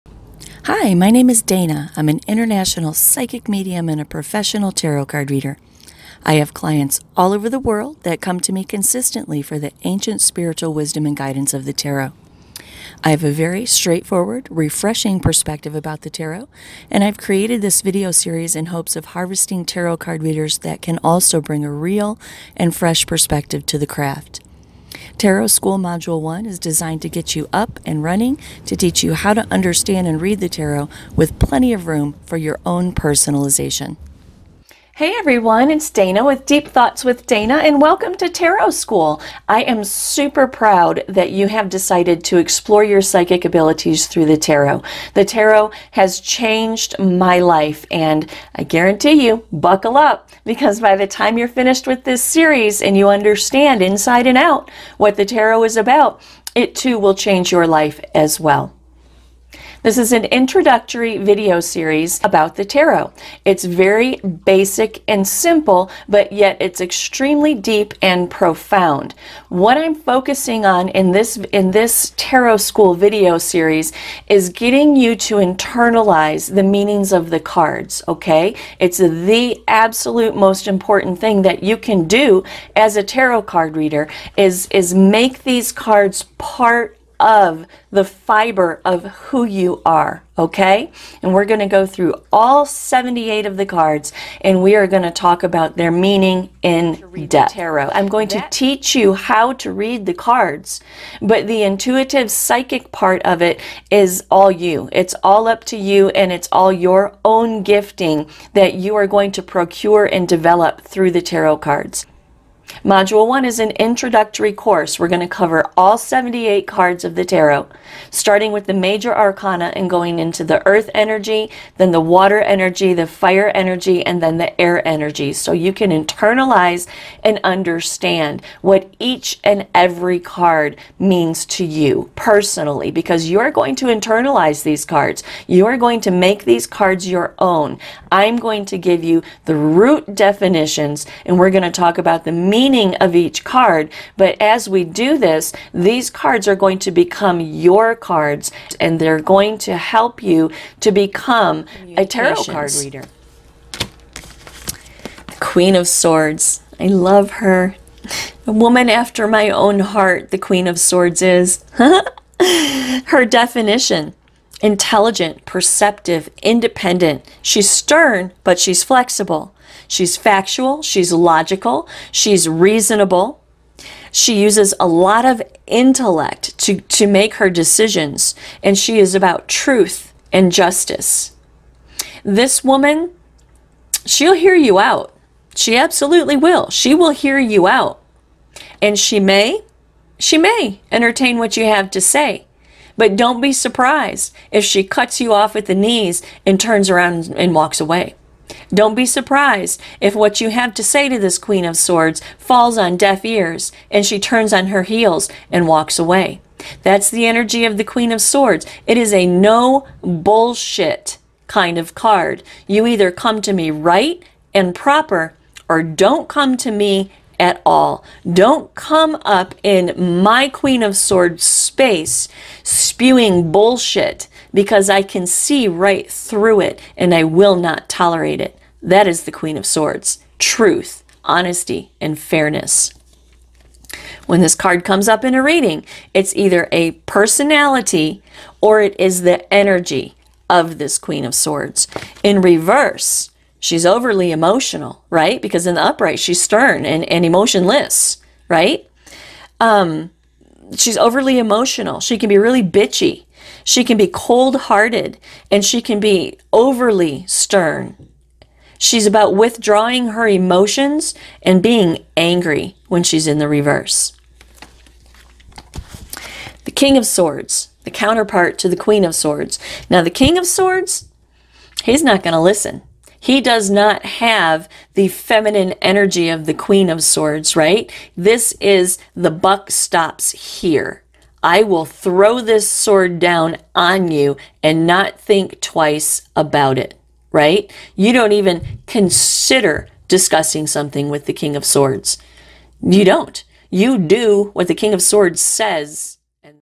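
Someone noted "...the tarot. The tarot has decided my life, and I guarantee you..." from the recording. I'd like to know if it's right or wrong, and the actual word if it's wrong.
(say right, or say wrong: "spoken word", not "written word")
wrong: "changed", not "decided".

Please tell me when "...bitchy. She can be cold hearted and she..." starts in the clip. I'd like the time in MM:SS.
04:12.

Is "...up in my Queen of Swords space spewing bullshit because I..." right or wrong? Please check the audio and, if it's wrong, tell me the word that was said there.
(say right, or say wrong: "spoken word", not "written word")
right.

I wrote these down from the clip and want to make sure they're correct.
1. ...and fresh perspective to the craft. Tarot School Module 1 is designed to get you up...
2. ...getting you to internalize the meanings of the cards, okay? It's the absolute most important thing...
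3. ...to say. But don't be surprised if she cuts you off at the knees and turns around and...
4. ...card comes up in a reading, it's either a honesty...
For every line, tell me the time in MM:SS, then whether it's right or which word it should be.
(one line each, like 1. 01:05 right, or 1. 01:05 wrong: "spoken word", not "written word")
1. 00:22 right
2. 01:14 right
3. 03:11 right
4. 03:54 wrong: "personality", not "honesty".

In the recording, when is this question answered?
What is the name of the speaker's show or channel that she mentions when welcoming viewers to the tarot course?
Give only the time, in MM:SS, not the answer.
00:36.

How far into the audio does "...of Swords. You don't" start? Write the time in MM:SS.
04:51.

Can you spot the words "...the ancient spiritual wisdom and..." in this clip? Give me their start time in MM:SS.
00:09.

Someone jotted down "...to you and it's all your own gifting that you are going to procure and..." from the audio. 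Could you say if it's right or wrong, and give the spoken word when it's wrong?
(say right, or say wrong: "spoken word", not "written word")
right.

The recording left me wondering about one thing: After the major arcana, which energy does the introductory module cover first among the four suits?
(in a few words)
earth energy.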